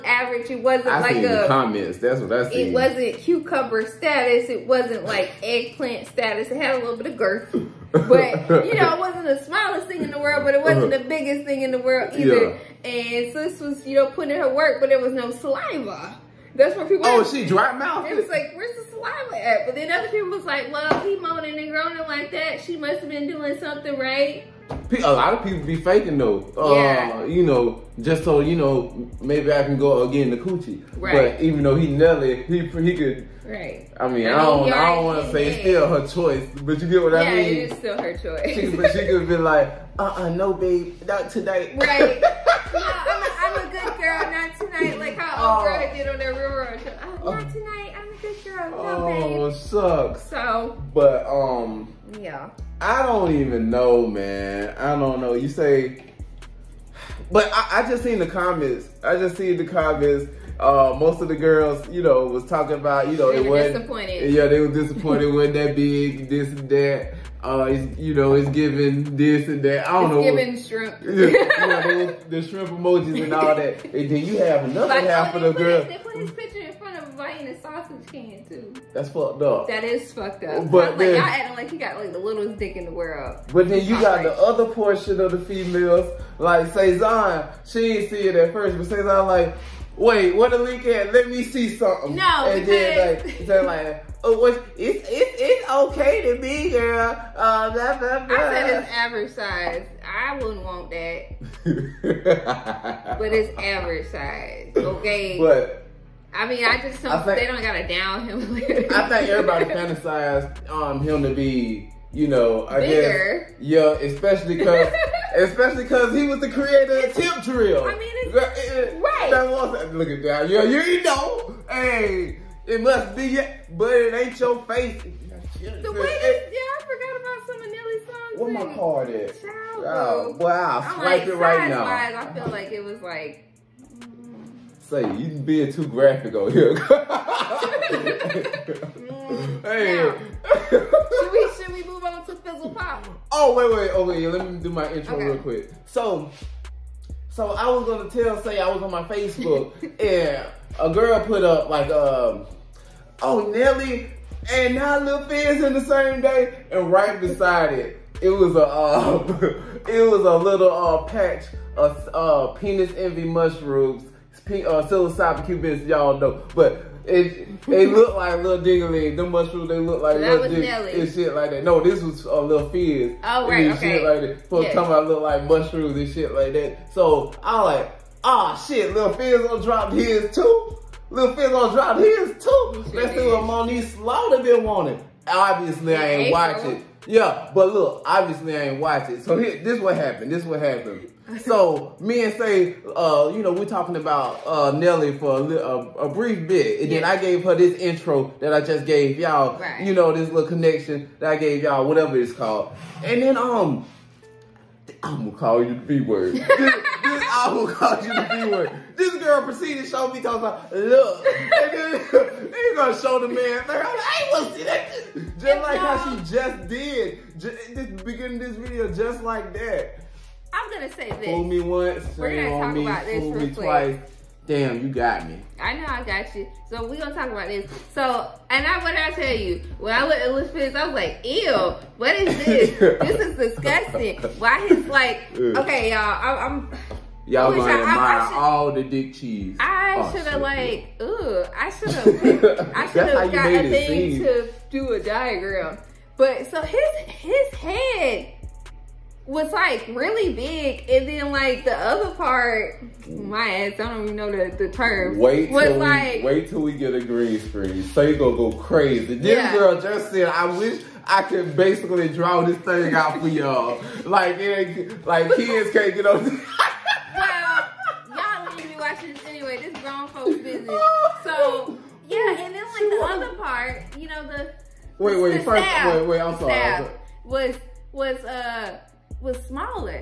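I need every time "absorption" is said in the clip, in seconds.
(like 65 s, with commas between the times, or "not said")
not said.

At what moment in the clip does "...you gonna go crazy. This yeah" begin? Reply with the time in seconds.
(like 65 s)
258 s.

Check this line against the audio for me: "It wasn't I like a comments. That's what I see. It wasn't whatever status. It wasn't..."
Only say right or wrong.
wrong.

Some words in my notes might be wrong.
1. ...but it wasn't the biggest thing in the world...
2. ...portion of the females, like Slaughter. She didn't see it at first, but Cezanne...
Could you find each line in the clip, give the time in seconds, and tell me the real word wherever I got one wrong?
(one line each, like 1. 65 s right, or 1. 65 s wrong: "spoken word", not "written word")
1. 10 s right
2. 84 s wrong: "Cezanne", not "Slaughter".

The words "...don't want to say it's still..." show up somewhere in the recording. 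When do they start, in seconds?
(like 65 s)
34 s.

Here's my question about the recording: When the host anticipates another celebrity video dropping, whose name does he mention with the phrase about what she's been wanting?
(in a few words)
Monique Slaughter.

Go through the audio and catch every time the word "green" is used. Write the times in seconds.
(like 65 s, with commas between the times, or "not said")
257 s.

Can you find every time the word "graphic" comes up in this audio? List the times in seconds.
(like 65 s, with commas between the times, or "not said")
135 s.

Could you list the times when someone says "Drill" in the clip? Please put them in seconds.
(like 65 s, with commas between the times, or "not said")
117 s.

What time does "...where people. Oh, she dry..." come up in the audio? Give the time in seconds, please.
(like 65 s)
16 s.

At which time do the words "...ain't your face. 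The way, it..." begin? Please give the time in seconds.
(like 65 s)
124 s.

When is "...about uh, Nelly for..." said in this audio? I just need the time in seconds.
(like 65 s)
193 s.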